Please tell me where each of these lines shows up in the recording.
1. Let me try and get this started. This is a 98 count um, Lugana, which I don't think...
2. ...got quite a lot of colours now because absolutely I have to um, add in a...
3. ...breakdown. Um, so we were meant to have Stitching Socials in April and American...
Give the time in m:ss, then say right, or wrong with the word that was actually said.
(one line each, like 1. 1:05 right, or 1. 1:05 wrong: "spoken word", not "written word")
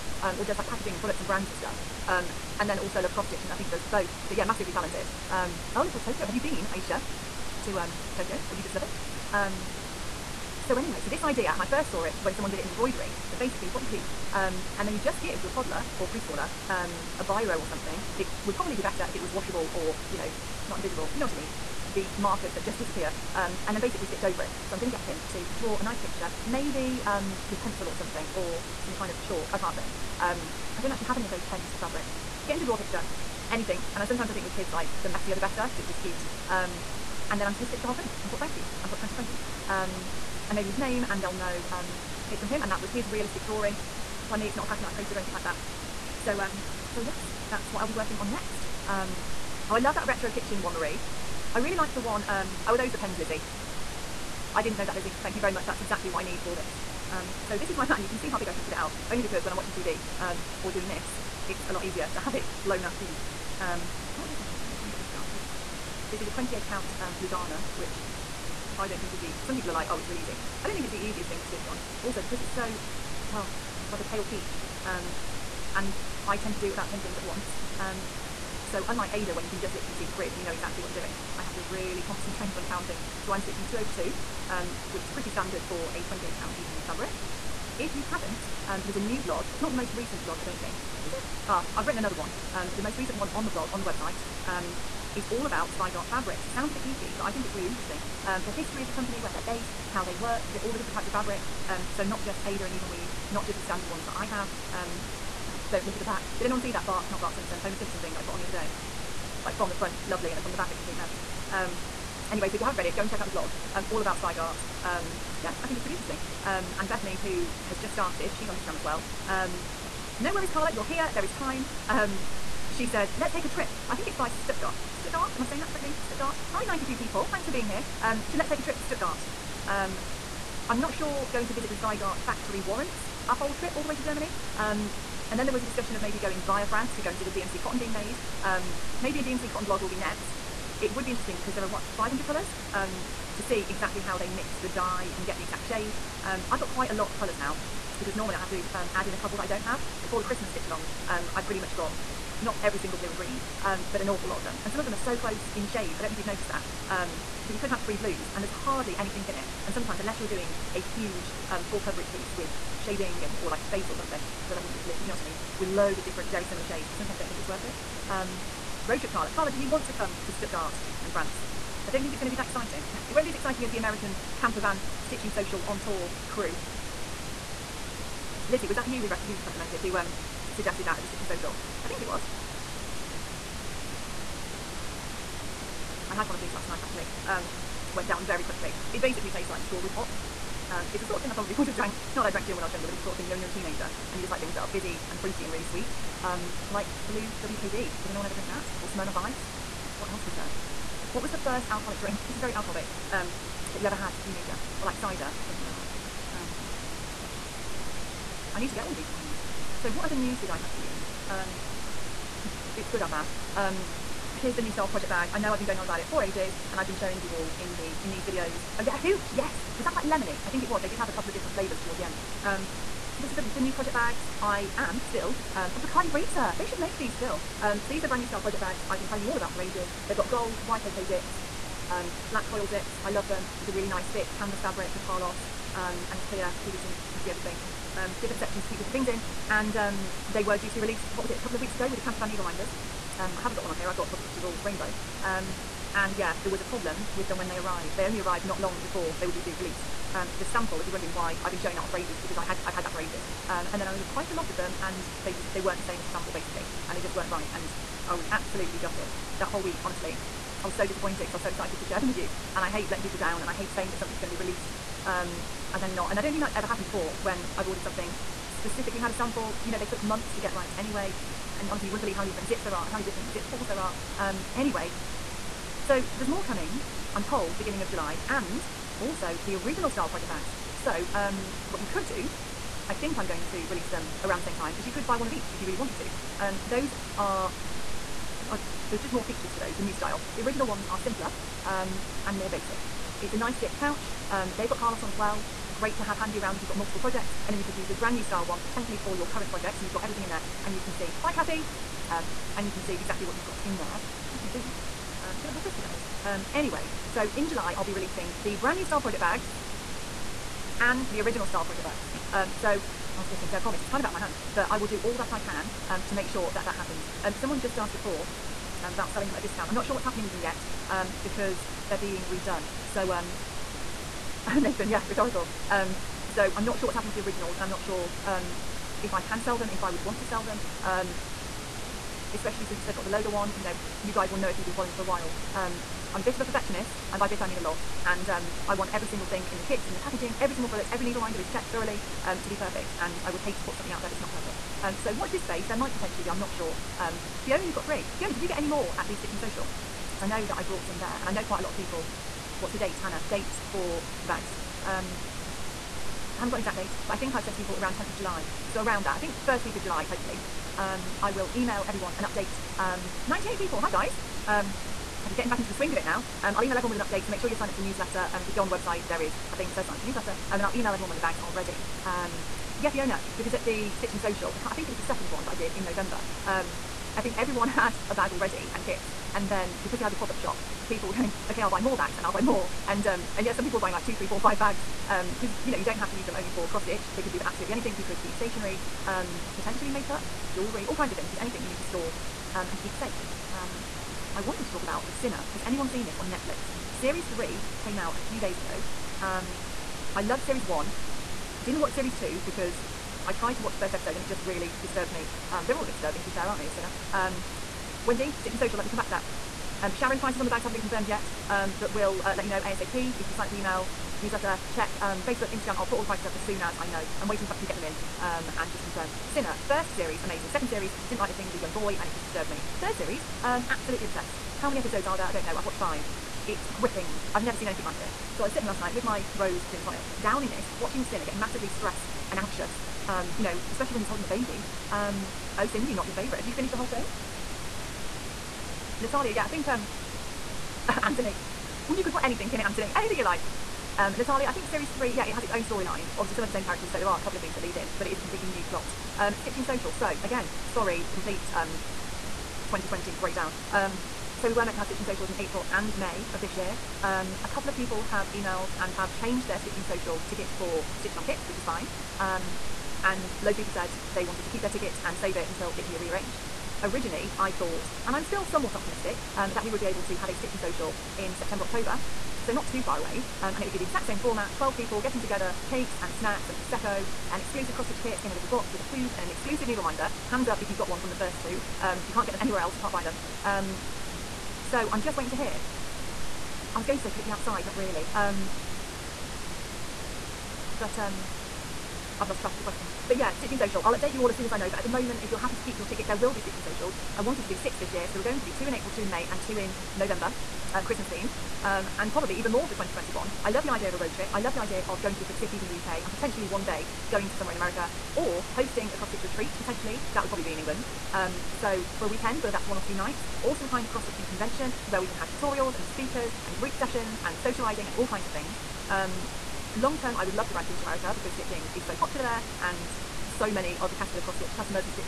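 1. 1:04 wrong: "28", not "98"
2. 2:26 wrong: "normally", not "absolutely"
3. 7:33 wrong: "May", not "American".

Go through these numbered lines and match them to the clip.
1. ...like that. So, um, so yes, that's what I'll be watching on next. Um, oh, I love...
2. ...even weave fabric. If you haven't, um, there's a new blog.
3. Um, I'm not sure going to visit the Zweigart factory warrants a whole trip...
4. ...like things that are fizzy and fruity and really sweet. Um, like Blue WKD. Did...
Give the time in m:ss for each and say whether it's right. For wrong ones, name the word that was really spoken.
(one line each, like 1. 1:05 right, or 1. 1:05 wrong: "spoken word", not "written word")
1. 0:45 wrong: "working", not "watching"
2. 1:26 right
3. 2:09 right
4. 3:14 right.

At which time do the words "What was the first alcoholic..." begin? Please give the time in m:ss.
3:21.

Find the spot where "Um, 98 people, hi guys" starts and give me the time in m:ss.
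6:02.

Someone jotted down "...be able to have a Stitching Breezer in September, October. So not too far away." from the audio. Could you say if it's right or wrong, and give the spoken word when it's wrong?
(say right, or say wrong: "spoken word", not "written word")
wrong: "Social", not "Breezer".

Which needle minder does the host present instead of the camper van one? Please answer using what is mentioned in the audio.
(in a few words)
Positivity Rules Rainbow.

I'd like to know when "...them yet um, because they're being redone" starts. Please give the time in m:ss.
5:20.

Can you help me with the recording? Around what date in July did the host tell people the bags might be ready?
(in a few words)
10th of July.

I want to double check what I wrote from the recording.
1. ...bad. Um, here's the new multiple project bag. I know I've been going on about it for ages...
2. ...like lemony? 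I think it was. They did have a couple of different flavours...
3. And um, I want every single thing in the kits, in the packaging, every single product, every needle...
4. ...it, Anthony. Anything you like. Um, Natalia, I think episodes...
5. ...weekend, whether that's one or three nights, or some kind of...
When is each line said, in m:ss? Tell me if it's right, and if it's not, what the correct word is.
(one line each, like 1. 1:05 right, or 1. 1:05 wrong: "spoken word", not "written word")
1. 3:33 wrong: "style", not "multiple"
2. 3:39 right
3. 5:38 right
4. 7:22 wrong: "series", not "episodes"
5. 8:32 wrong: "two", not "three".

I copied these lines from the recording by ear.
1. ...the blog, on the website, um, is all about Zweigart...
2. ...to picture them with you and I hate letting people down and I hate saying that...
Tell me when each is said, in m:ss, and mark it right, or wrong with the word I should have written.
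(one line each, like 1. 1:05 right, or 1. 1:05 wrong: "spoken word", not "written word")
1. 1:33 right
2. 4:21 wrong: "share", not "picture".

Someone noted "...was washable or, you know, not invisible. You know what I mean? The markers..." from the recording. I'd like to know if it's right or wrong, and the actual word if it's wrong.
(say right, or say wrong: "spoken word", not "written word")
right.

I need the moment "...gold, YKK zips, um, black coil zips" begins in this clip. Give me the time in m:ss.
3:50.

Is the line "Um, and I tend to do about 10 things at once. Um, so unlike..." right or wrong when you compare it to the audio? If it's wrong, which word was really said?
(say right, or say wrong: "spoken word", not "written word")
right.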